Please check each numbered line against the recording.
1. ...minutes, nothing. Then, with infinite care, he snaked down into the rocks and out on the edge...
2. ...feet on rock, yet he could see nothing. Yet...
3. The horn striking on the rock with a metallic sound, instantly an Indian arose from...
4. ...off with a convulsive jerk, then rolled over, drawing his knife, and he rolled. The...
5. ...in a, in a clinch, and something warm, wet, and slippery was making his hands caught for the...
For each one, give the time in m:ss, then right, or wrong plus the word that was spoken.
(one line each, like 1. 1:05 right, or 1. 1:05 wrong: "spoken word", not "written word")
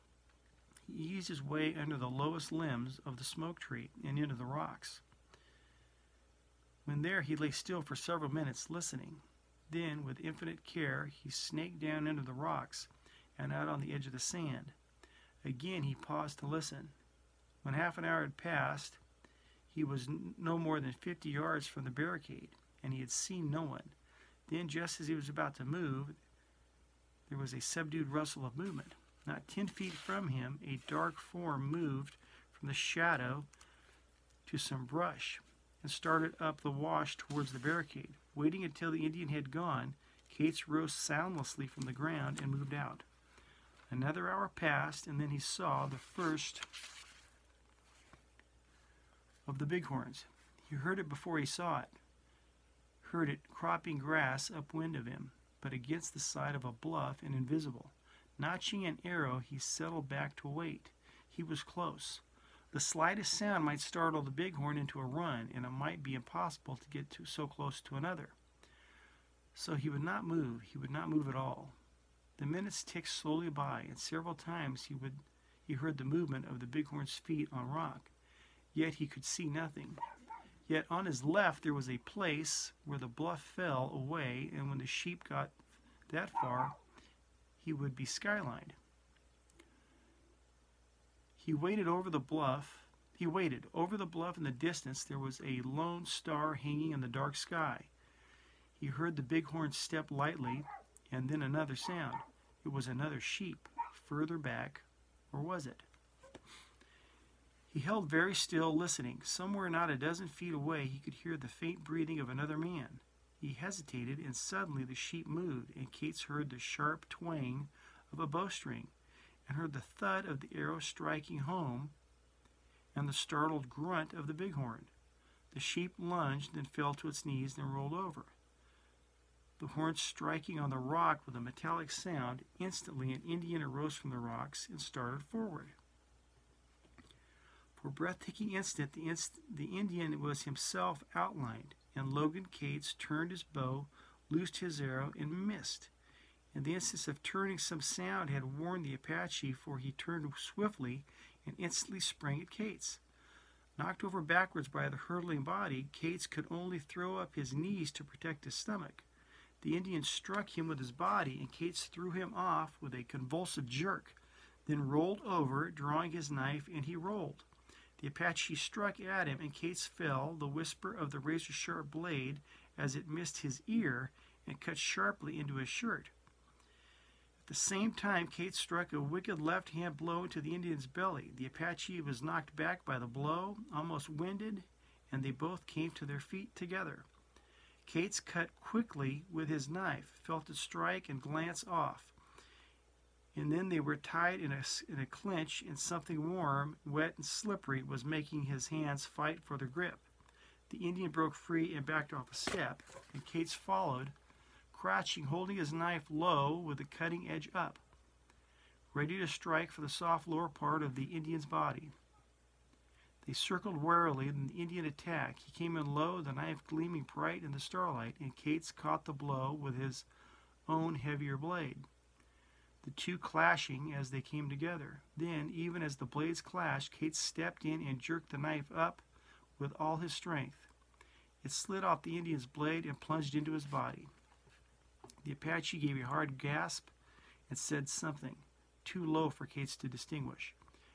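1. 0:08 wrong: "listening", not "nothing"
2. 1:17 right
3. 2:09 right
4. 2:42 right
5. 3:14 wrong: "fight", not "caught".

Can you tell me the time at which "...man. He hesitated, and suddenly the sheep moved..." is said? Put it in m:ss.
1:52.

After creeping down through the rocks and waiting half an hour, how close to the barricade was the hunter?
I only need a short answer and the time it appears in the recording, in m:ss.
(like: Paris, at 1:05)
50 yards, at 0:21.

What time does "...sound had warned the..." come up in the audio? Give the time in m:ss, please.
2:27.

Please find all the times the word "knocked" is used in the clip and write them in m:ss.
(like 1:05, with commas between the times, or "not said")
2:33, 3:02.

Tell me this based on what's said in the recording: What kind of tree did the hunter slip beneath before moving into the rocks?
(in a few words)
smoke tree.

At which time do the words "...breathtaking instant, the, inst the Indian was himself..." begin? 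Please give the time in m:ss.
2:17.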